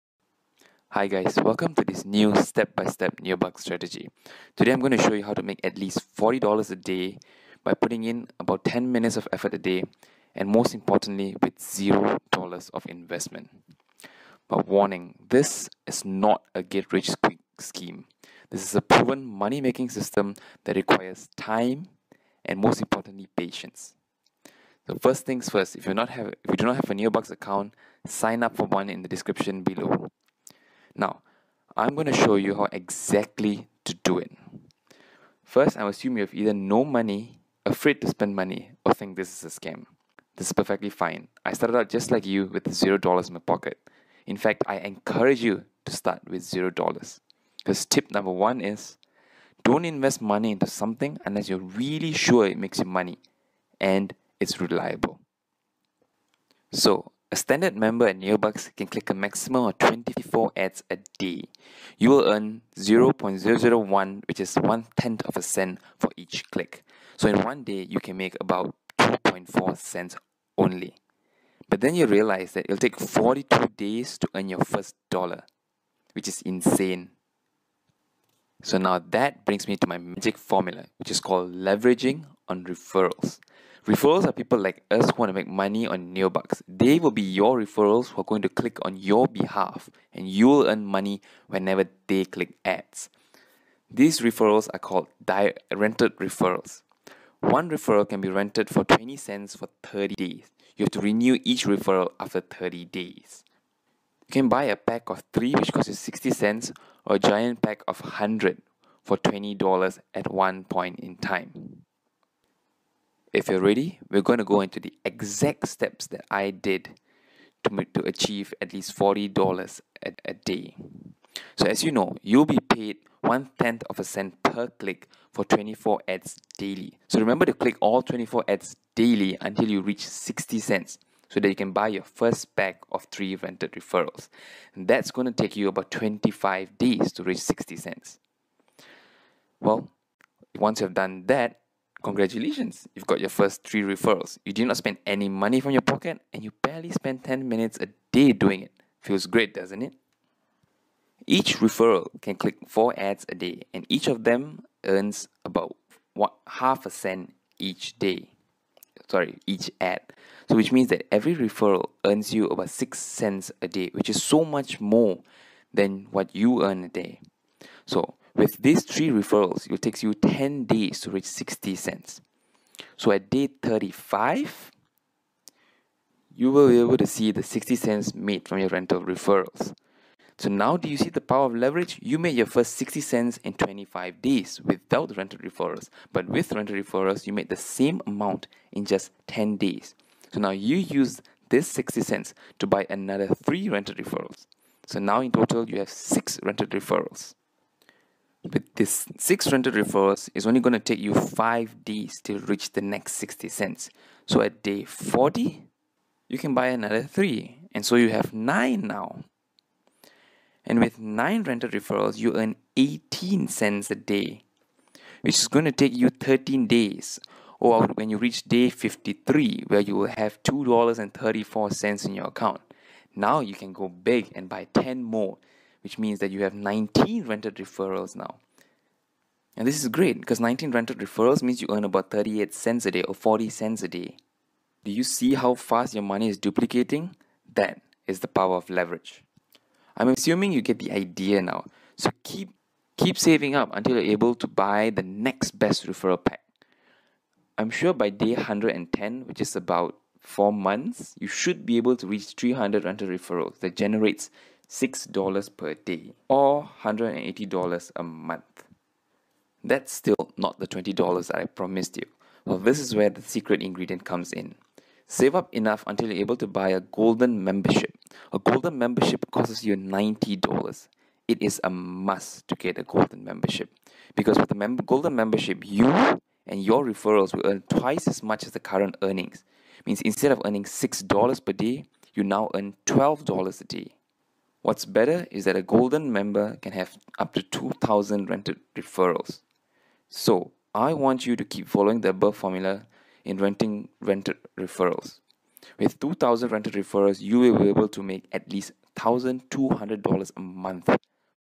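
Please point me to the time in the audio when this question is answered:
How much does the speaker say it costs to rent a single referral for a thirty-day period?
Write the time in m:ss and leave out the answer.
1:38.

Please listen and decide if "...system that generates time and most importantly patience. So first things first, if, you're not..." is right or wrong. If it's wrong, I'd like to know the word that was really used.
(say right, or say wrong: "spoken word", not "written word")
wrong: "requires", not "generates".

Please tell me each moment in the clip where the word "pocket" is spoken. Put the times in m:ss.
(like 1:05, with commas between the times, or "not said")
0:43, 2:25.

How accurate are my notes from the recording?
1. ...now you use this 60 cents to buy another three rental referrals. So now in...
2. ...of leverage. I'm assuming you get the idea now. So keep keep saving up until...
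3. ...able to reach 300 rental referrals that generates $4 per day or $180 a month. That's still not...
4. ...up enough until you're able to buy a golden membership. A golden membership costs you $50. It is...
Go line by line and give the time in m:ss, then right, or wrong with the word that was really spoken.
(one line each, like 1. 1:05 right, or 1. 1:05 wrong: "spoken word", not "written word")
1. 3:10 right
2. 3:58 right
3. 4:11 wrong: "6", not "4"
4. 4:25 wrong: "90", not "50".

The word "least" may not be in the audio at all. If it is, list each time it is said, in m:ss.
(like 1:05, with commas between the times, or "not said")
0:05, 1:58, 4:58.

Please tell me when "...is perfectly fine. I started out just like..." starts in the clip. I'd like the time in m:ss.
0:40.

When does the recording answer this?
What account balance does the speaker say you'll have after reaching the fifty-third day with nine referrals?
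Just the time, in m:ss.
3:40.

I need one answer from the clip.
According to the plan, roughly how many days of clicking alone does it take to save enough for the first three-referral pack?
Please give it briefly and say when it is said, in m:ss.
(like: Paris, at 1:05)
25 days, at 2:15.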